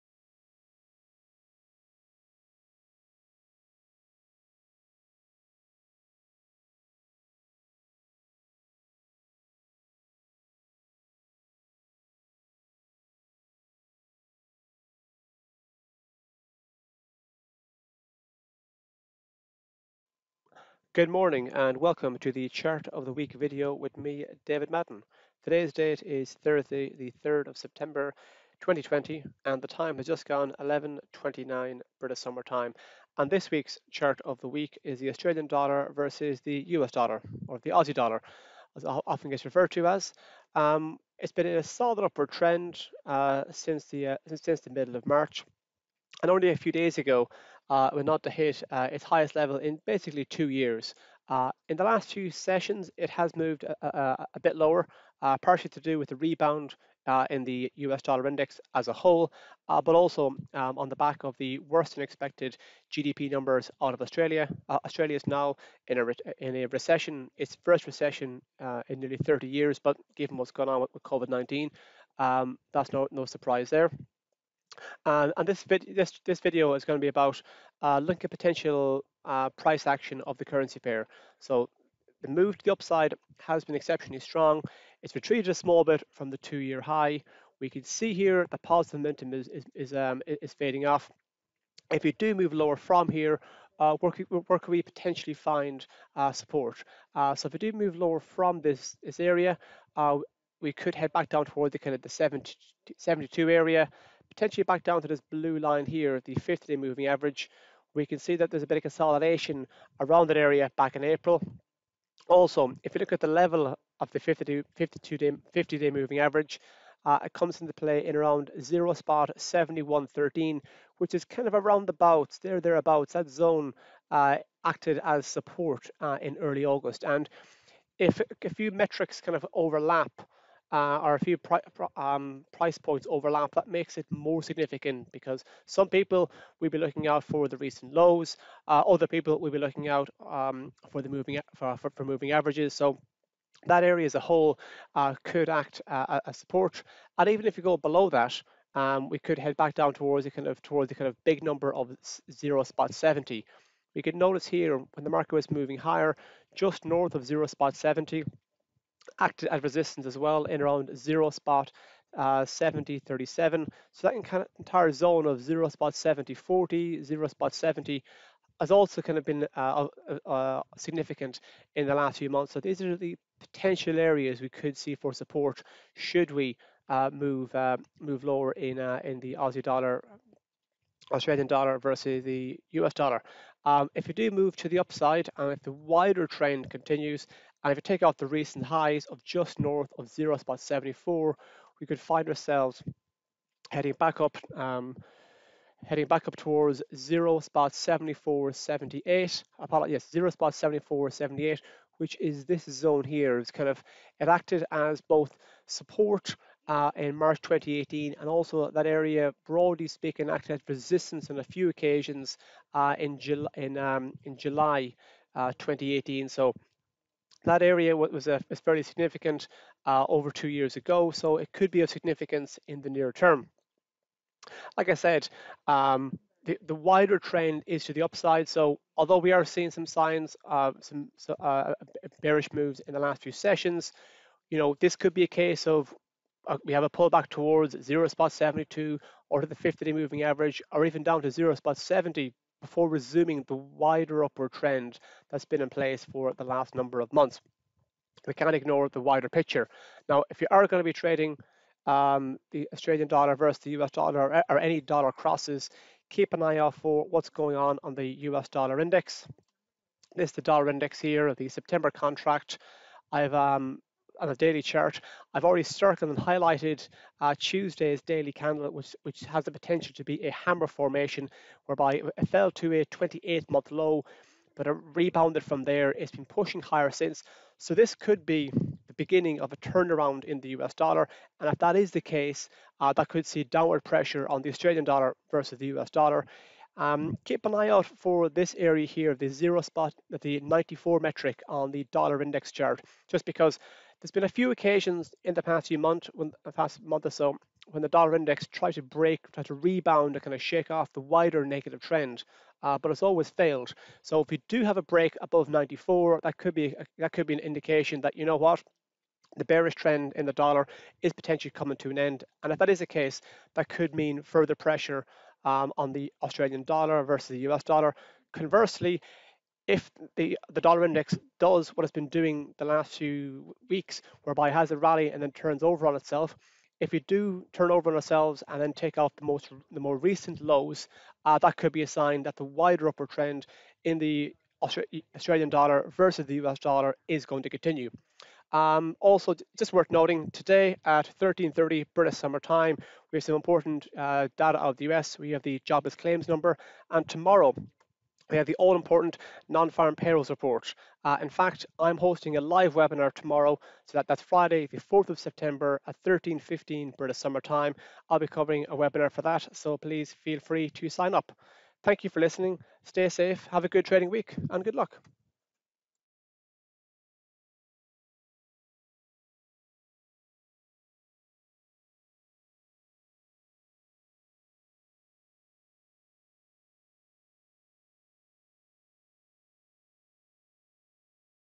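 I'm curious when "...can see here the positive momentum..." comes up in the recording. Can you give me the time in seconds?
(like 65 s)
87 s.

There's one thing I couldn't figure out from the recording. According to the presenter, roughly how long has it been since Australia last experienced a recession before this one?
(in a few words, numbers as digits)
nearly 30 years.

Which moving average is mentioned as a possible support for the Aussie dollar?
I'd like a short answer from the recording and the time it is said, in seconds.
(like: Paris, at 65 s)
50-day moving average, at 106 s.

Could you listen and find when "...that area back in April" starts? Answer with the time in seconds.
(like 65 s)
110 s.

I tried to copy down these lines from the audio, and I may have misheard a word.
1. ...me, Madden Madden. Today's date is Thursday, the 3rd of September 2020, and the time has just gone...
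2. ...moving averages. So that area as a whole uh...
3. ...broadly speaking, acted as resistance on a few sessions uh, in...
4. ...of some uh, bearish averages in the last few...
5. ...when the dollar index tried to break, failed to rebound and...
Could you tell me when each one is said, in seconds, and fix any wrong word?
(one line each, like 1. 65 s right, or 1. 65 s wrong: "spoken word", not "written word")
1. 23 s wrong: "David", not "Madden"
2. 142 s right
3. 209 s wrong: "occasions", not "sessions"
4. 230 s wrong: "moves", not "averages"
5. 297 s wrong: "tried", not "failed".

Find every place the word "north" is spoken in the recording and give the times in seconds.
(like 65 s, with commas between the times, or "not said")
156 s, 189 s.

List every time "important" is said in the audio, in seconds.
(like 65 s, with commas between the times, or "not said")
343 s, 348 s.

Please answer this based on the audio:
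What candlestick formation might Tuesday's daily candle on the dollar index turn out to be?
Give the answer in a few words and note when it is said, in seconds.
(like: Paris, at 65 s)
hammer, at 270 s.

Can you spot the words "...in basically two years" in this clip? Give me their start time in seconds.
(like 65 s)
49 s.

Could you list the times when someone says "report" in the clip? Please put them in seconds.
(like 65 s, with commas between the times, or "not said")
350 s.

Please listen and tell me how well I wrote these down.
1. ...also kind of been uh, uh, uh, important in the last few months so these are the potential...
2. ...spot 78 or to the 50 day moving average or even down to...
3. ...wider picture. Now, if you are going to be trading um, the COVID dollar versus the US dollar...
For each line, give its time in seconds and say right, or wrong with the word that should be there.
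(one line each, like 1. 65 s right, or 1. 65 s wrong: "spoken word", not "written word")
1. 168 s wrong: "significant", not "important"
2. 238 s wrong: "72", not "78"
3. 249 s wrong: "Australian", not "COVID".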